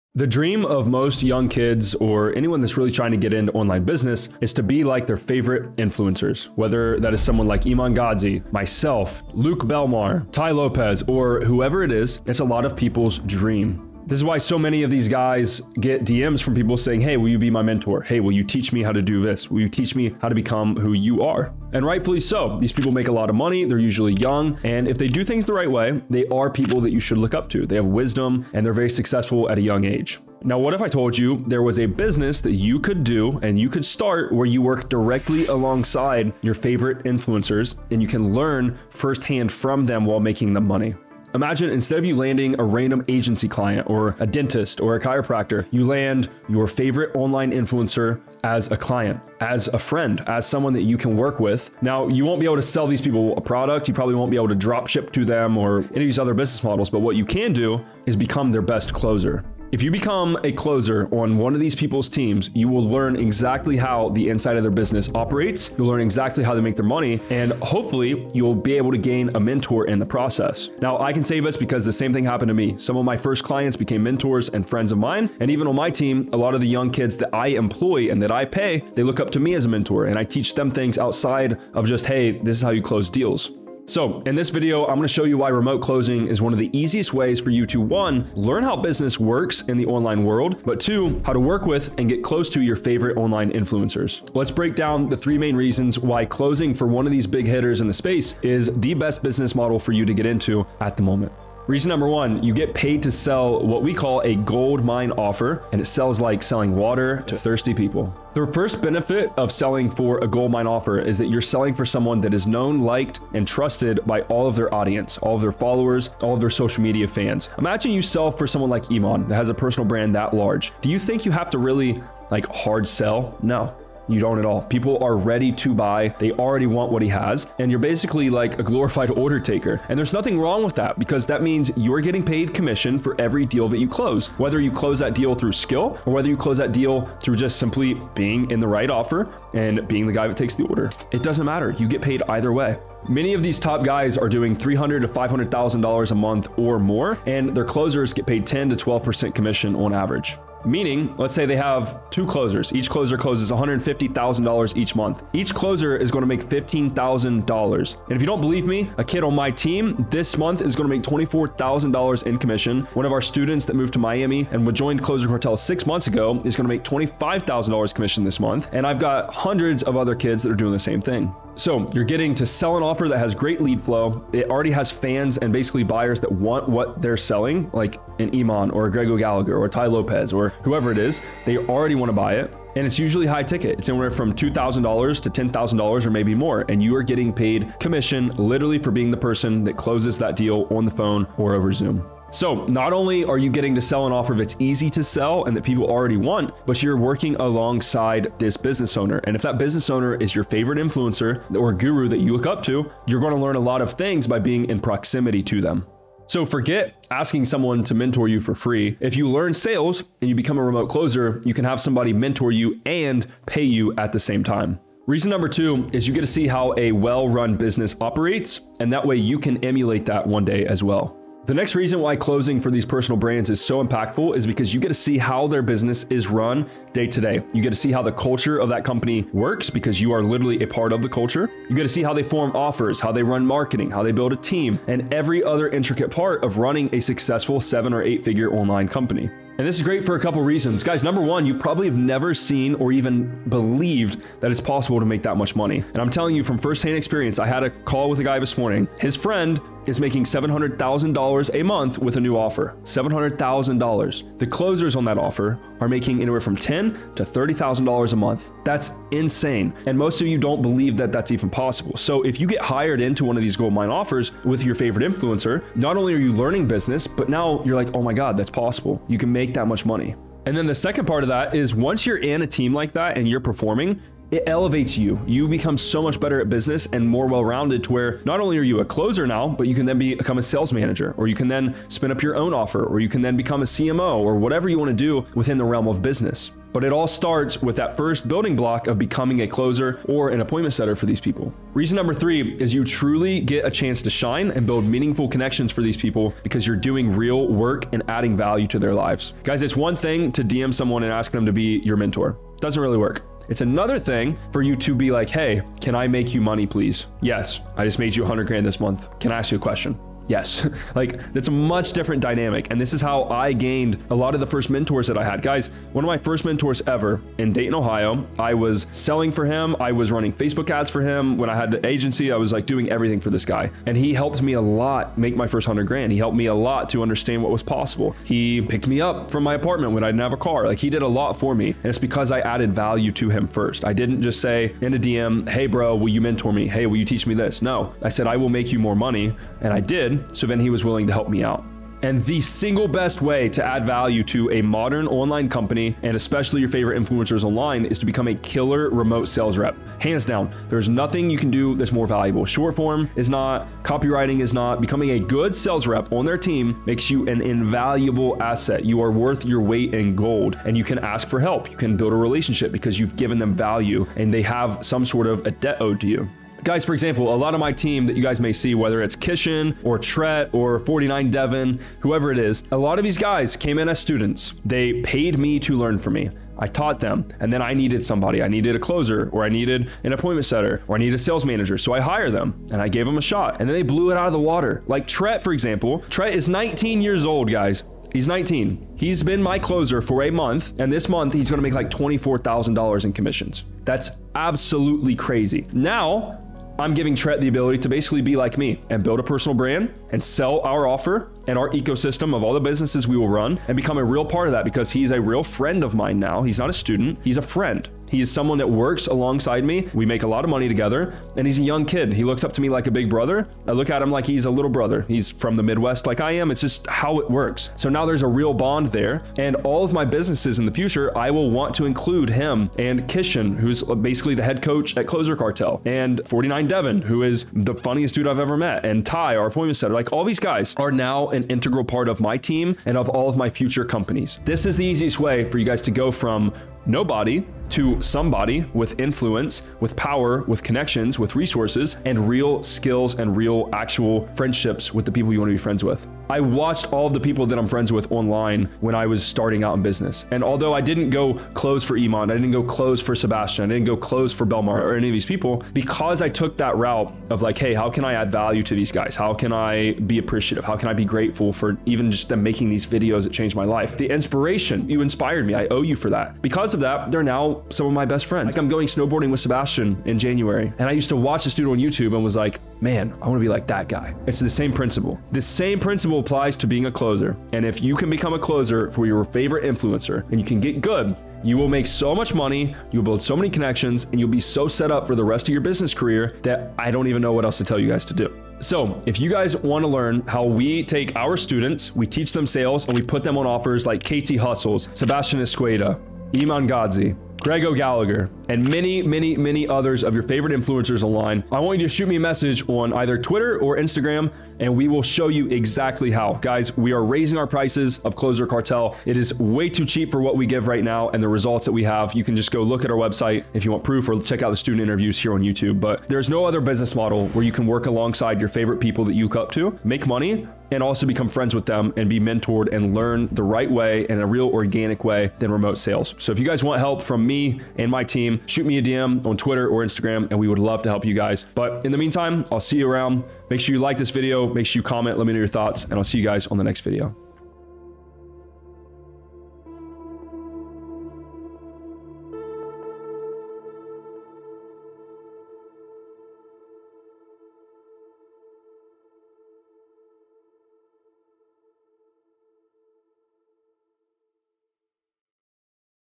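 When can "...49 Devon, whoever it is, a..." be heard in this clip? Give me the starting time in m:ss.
6:10.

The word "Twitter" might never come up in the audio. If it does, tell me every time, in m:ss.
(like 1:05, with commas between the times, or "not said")
8:23, 8:49.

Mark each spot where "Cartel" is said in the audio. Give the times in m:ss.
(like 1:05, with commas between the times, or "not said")
2:45, 7:05, 8:28.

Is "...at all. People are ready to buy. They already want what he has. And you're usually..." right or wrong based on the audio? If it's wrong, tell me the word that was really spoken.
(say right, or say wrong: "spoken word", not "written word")
wrong: "basically", not "usually".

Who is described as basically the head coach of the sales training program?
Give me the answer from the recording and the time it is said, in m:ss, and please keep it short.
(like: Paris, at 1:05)
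Kishan, at 7:03.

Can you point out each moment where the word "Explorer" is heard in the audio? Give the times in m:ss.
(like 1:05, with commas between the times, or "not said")
not said.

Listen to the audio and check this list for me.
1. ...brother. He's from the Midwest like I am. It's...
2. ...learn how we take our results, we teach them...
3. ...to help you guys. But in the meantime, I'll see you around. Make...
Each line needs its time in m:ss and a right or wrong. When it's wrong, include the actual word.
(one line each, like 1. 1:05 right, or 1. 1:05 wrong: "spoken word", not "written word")
1. 6:54 right
2. 8:09 wrong: "students", not "results"
3. 8:50 right.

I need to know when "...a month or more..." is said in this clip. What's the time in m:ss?
2:26.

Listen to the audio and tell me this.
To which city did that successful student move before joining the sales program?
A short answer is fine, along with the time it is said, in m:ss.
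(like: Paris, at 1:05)
Miami, at 2:43.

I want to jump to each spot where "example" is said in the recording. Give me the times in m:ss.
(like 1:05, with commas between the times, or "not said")
6:06, 6:25.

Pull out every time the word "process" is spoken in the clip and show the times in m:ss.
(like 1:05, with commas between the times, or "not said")
1:10.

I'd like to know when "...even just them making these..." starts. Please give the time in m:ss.
7:41.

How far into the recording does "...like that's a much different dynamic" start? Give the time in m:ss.
5:10.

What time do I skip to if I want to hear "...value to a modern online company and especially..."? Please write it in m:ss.
5:43.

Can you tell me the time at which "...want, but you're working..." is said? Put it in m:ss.
3:16.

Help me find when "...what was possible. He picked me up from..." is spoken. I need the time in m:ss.
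5:27.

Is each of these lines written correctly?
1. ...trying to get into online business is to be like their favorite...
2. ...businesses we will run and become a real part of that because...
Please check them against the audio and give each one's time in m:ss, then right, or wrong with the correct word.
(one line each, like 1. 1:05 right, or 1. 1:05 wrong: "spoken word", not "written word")
1. 0:02 right
2. 6:42 right.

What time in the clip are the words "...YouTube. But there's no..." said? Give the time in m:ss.
8:35.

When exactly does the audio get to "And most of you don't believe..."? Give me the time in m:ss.
4:19.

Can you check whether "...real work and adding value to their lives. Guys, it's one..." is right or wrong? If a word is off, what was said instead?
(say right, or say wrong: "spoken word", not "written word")
right.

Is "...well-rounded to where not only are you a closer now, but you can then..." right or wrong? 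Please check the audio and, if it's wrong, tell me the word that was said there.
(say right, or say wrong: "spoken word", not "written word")
right.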